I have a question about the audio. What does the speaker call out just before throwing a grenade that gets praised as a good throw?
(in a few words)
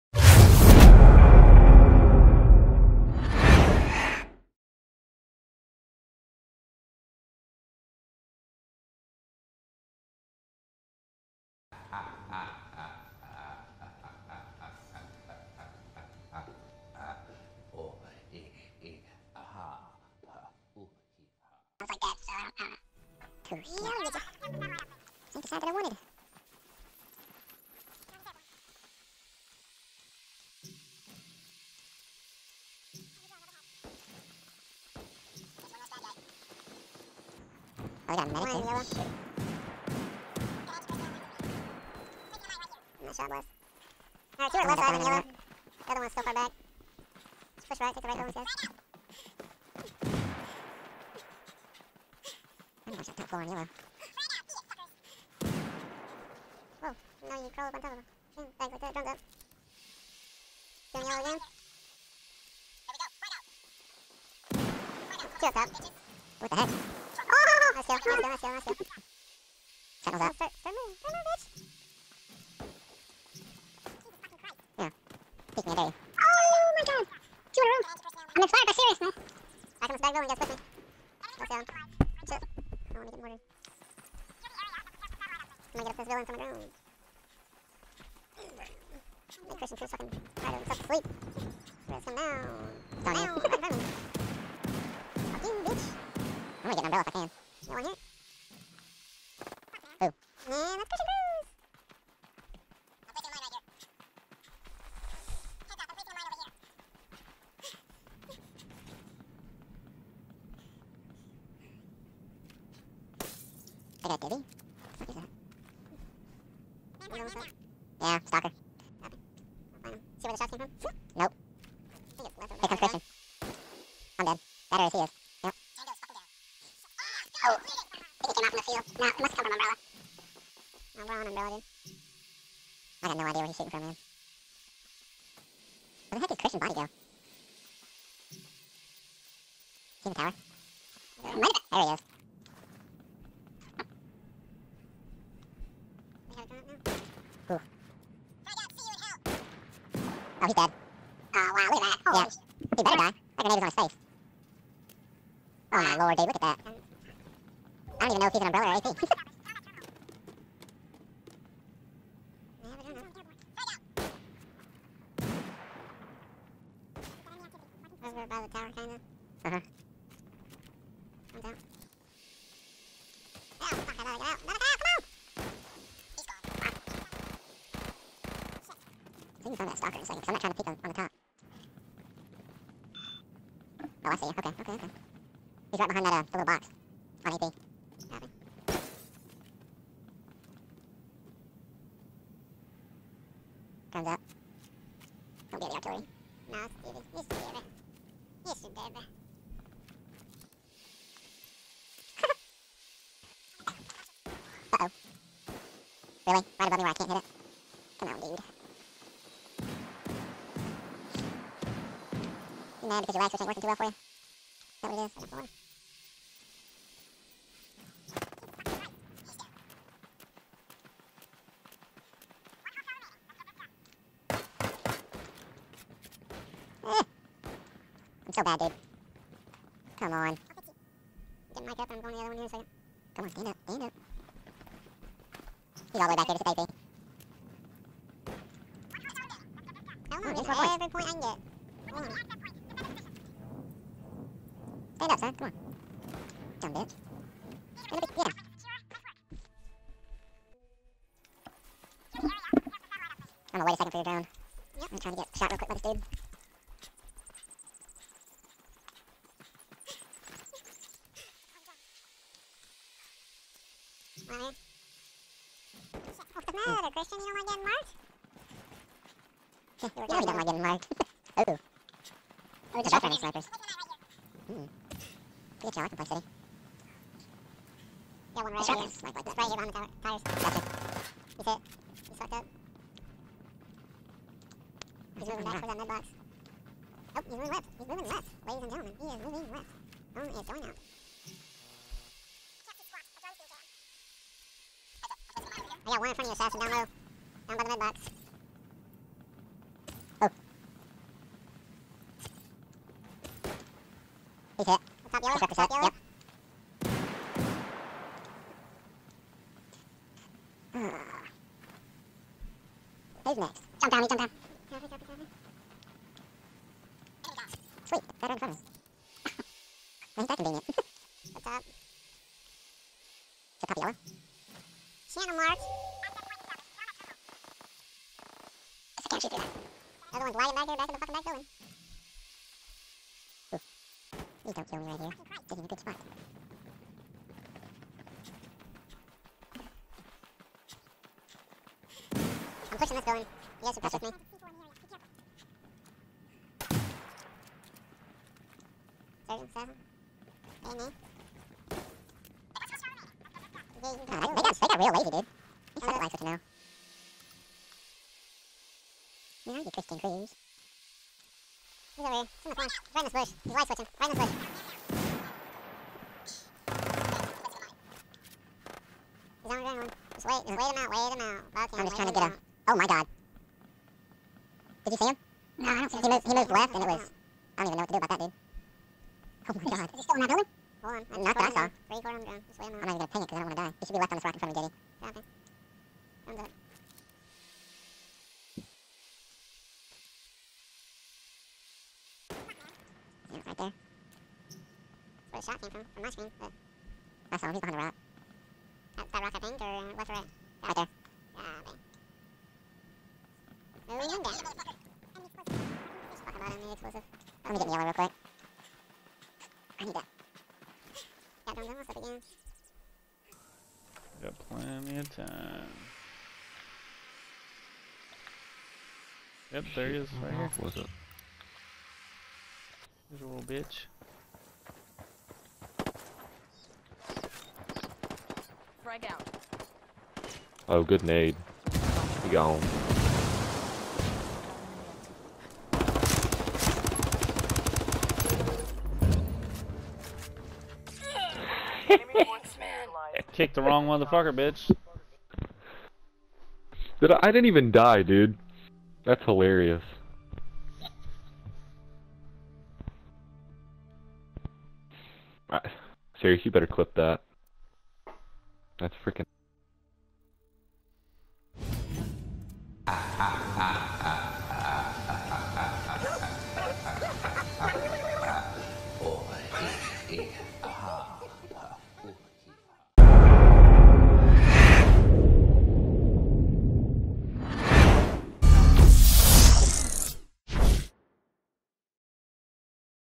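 Frag out.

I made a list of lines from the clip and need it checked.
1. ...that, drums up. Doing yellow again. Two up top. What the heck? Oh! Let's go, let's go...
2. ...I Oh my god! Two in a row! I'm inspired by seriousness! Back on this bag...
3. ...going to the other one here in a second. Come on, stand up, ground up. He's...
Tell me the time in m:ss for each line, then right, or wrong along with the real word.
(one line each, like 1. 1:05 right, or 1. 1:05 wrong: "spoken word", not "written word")
1. 0:58 right
2. 1:15 right
3. 3:52 wrong: "stand", not "ground".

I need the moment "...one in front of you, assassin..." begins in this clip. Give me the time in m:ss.
4:55.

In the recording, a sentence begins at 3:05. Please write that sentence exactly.
He's right behind that uh, little box on AP.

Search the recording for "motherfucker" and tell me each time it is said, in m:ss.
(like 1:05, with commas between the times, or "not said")
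7:23.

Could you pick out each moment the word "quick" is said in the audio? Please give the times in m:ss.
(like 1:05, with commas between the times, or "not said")
4:15, 6:47.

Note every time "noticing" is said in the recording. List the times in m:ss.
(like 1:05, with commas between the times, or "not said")
not said.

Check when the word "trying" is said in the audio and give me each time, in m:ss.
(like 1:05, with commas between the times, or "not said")
3:00, 4:14, 6:11.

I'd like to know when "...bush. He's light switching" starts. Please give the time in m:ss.
6:02.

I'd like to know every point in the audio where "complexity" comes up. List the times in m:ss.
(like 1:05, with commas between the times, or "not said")
4:35.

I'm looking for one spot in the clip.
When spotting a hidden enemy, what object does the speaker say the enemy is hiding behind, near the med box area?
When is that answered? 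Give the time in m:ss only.
4:40.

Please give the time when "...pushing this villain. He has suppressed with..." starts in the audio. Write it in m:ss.
5:42.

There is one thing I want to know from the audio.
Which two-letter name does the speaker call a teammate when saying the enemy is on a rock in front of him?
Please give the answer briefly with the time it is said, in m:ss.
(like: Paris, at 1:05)
JD, at 6:24.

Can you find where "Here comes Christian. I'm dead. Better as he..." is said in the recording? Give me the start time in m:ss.
2:02.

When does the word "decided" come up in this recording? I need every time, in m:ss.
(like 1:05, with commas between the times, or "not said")
0:25.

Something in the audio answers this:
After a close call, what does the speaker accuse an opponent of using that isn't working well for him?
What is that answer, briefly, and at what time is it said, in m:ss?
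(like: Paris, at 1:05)
lag switch, at 3:33.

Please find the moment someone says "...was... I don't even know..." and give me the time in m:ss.
6:16.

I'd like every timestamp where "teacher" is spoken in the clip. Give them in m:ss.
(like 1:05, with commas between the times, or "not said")
not said.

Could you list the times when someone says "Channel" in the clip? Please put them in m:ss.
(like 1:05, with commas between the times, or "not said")
5:25.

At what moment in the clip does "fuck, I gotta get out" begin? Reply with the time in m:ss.
2:53.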